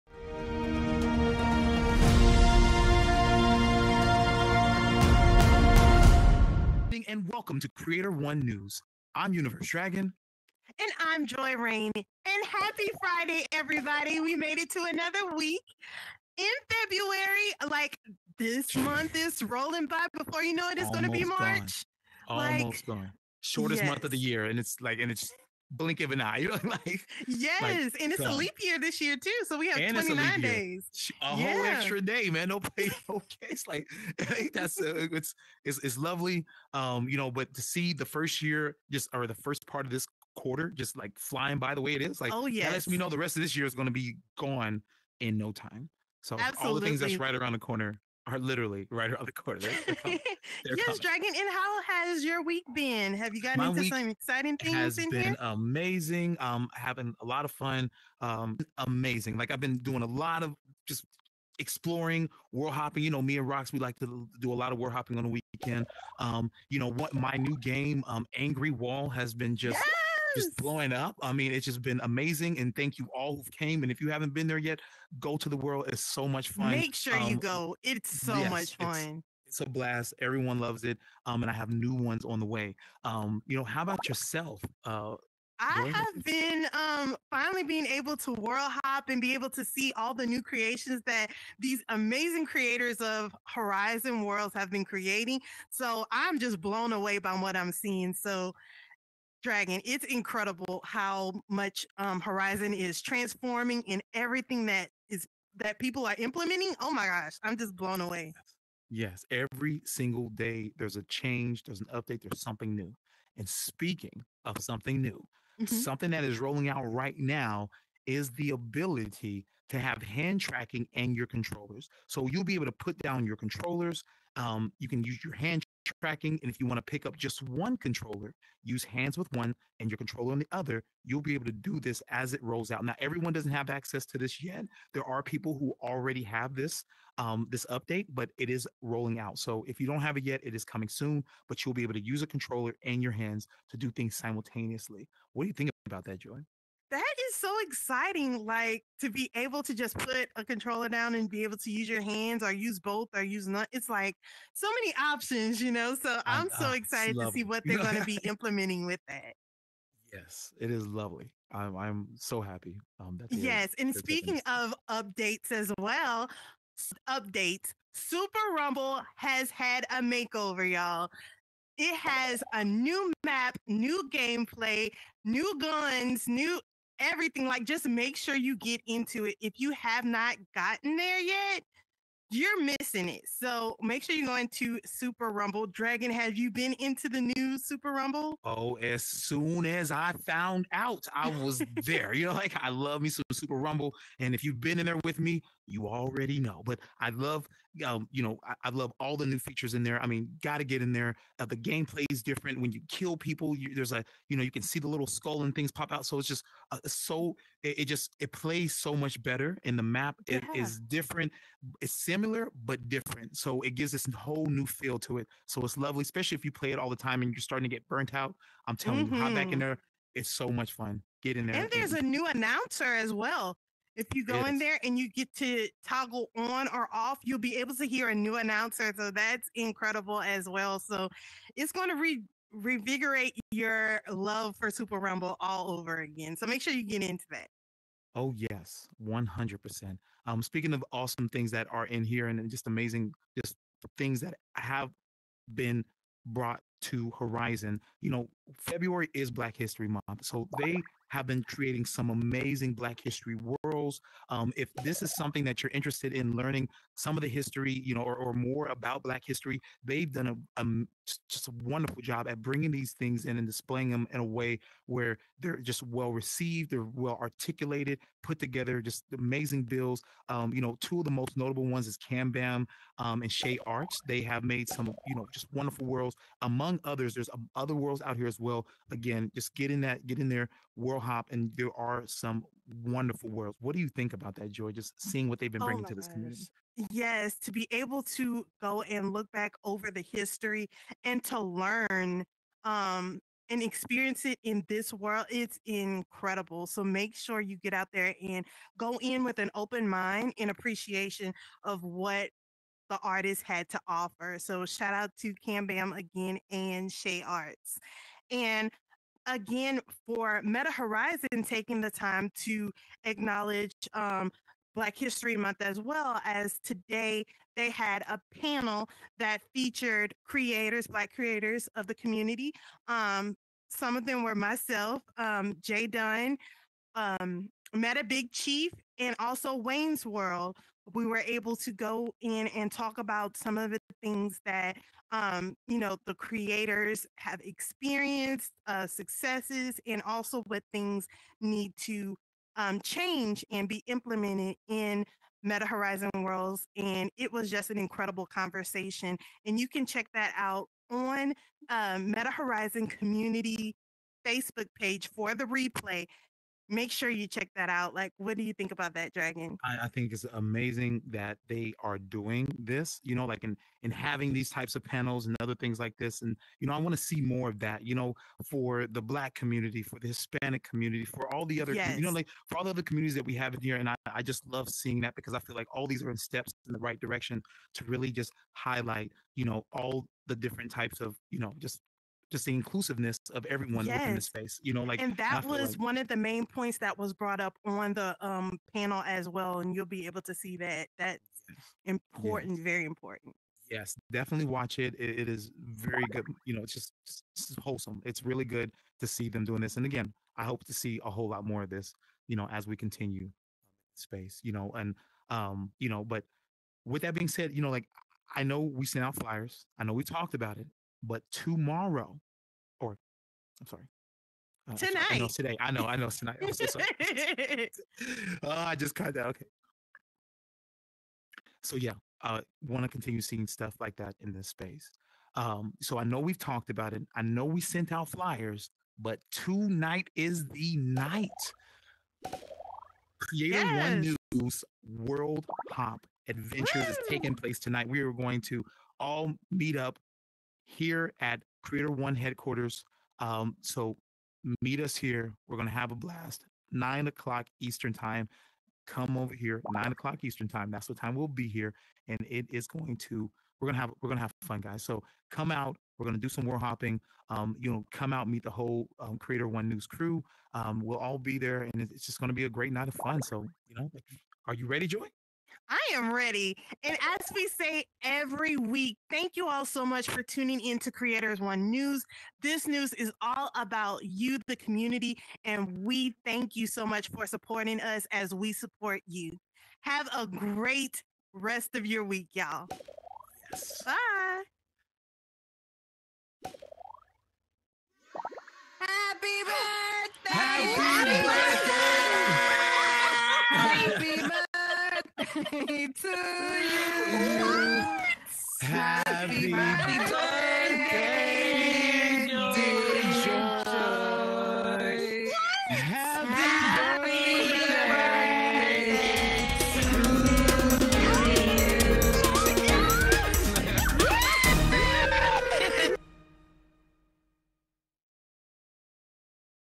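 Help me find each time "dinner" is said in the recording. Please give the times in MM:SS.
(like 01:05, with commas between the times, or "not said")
not said.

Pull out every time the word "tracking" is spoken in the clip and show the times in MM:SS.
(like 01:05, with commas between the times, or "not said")
02:00, 02:05.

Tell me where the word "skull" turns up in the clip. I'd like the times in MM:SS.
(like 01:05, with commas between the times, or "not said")
03:25.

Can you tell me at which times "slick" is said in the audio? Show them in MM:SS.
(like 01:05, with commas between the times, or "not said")
not said.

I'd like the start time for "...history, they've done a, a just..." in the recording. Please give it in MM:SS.
04:19.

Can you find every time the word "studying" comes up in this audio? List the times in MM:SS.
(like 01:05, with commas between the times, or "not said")
not said.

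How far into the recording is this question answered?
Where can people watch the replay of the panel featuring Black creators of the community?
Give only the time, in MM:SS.
05:52.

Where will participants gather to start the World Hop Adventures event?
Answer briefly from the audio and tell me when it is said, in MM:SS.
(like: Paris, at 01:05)
Creator One headquarters, at 07:21.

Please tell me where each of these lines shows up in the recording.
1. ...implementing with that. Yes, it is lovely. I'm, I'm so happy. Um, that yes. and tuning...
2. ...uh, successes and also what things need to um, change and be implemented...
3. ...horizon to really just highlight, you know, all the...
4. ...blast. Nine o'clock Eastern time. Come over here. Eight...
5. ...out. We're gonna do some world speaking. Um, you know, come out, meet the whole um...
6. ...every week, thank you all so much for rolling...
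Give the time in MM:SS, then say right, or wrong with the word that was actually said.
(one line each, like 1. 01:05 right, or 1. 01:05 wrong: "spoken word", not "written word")
1. 02:38 wrong: "speaking", not "tuning"
2. 05:38 right
3. 06:16 wrong: "direction", not "horizon"
4. 07:25 wrong: "Nine", not "Eight"
5. 07:35 wrong: "hopping", not "speaking"
6. 07:48 wrong: "tuning", not "rolling".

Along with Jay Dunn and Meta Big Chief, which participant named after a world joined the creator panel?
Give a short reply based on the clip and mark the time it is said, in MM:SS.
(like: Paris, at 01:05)
Wayne's World, at 05:29.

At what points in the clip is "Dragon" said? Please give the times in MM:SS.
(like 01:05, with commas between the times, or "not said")
00:09, 00:51, 01:39, 03:05, 05:59.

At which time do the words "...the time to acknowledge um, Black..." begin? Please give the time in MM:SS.
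05:11.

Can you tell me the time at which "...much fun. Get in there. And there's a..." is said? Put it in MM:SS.
03:40.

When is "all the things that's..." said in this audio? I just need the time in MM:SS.
00:46.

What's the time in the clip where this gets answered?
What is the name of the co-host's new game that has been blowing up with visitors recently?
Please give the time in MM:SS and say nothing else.
01:08.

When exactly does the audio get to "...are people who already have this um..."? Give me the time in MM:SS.
02:15.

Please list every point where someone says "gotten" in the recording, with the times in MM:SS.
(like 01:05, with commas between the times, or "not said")
00:53, 03:00.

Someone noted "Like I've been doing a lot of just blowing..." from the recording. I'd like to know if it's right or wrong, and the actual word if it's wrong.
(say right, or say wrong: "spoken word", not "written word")
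wrong: "exploring", not "blowing".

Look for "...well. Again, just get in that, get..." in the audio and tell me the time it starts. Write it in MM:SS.
04:38.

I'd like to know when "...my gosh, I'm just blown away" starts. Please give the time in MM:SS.
01:46.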